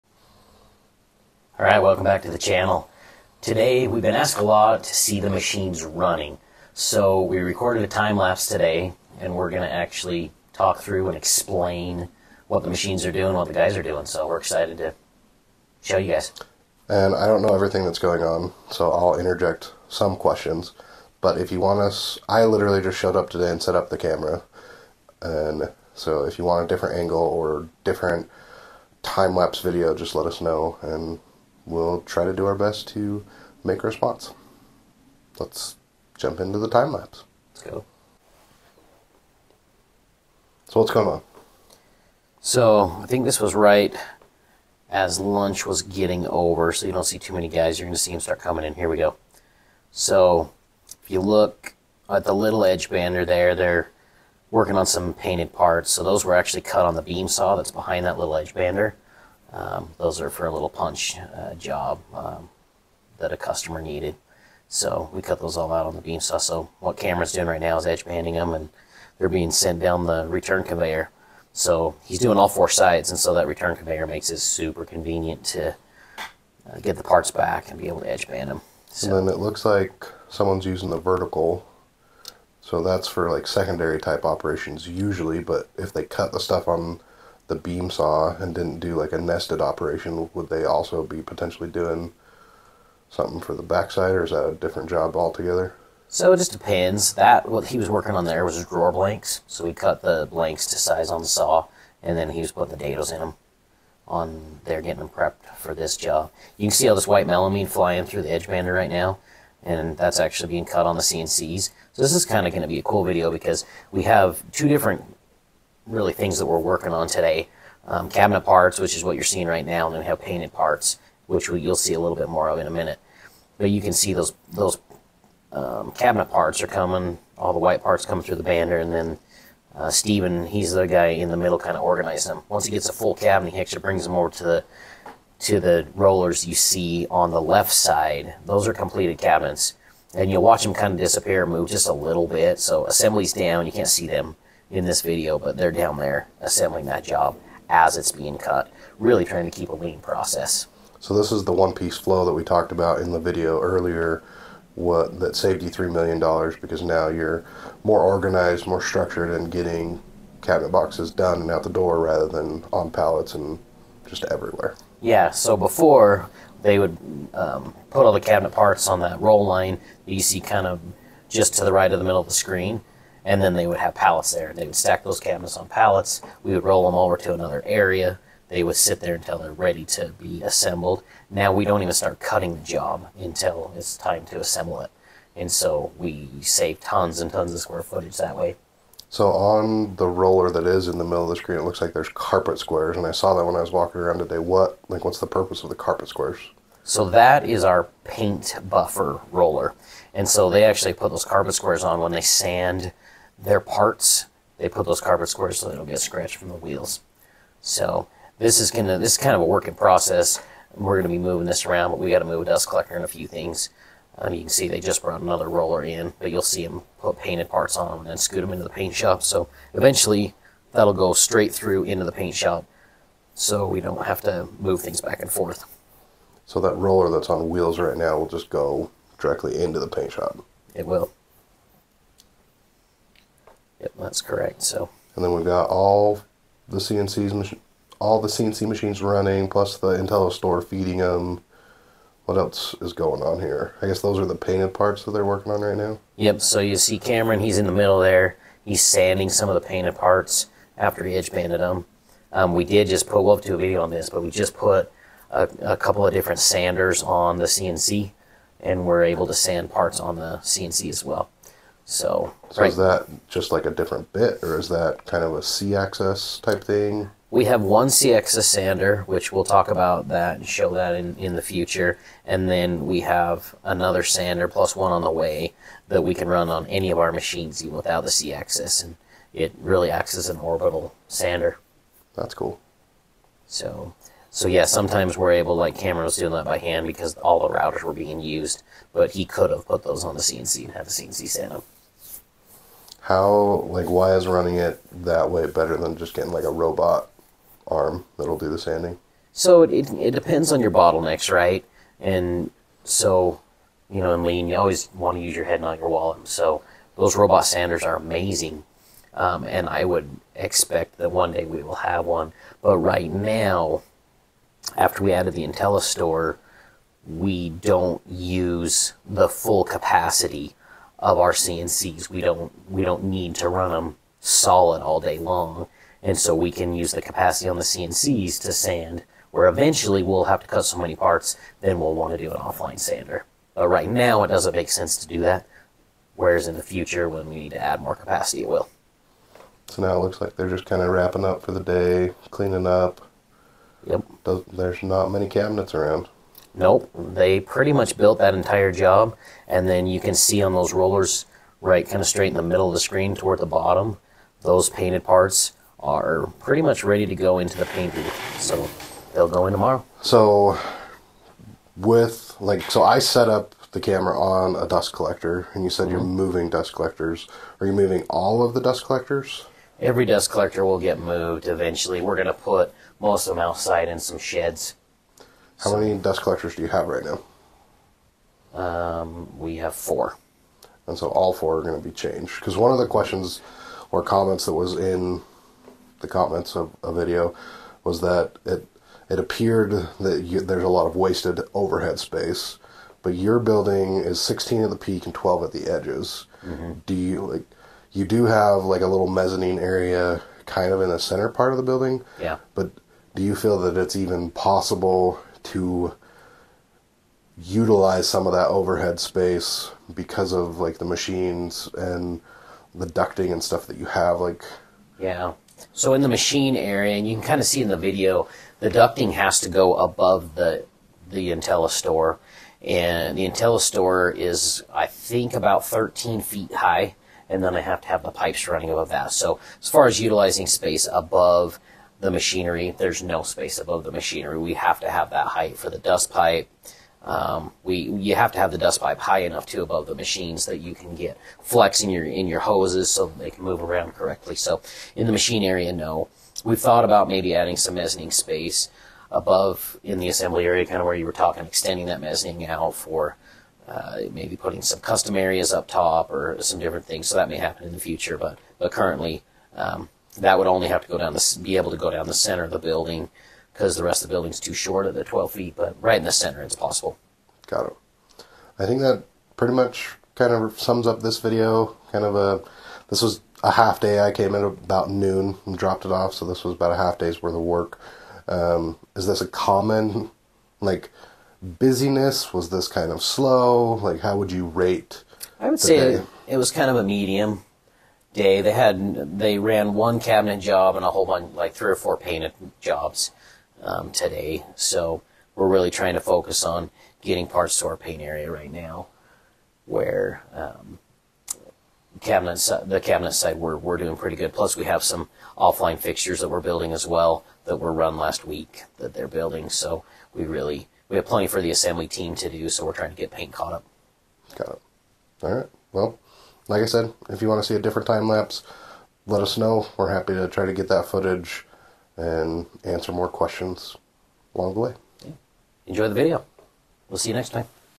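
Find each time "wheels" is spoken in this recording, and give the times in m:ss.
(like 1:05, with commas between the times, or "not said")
3:26, 3:47.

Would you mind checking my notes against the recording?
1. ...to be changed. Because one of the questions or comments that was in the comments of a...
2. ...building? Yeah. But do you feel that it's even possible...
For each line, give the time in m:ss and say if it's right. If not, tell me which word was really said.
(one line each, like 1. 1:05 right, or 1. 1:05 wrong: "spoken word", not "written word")
1. 6:21 right
2. 6:41 right.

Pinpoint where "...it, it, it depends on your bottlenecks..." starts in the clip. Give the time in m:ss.
4:59.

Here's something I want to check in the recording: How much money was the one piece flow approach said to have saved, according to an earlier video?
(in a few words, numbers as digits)
$3 million.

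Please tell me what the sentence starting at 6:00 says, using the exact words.
So with like, so I set up the camera on a dust collector, and you said mm-hmm.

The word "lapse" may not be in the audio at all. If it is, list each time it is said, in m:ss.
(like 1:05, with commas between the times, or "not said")
0:08, 0:29, 0:36, 8:38.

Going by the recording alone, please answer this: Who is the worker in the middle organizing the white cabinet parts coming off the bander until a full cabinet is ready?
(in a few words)
Steven.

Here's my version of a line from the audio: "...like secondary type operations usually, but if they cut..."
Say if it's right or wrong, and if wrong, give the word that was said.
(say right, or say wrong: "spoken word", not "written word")
right.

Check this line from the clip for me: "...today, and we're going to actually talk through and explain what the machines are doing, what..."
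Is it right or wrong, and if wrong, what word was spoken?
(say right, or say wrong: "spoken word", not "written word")
right.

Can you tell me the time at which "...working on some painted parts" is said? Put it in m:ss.
0:54.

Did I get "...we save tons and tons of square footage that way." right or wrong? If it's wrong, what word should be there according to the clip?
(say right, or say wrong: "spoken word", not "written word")
right.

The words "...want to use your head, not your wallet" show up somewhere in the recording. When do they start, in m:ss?
5:04.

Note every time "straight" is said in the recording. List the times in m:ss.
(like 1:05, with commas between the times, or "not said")
3:41, 5:52.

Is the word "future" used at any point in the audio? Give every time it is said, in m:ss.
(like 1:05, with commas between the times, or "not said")
4:31, 5:36, 7:37.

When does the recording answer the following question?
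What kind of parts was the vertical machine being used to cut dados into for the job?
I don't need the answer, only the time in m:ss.
1:38.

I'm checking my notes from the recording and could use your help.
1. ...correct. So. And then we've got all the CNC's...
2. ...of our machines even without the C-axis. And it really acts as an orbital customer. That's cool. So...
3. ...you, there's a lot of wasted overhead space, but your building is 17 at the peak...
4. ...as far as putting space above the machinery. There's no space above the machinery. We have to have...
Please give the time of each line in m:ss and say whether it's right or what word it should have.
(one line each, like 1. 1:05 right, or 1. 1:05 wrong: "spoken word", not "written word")
1. 3:54 right
2. 4:36 wrong: "sander", not "customer"
3. 6:30 wrong: "16", not "17"
4. 7:09 wrong: "utilizing", not "putting".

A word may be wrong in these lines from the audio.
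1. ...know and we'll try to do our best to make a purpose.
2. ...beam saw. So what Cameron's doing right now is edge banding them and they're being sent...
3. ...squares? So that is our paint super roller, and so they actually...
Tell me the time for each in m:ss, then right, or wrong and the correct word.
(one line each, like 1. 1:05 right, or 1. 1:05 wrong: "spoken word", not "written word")
1. 0:30 wrong: "response", not "purpose"
2. 1:06 right
3. 3:16 wrong: "buffer", not "super".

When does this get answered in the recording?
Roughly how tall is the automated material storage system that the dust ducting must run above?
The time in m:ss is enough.
7:05.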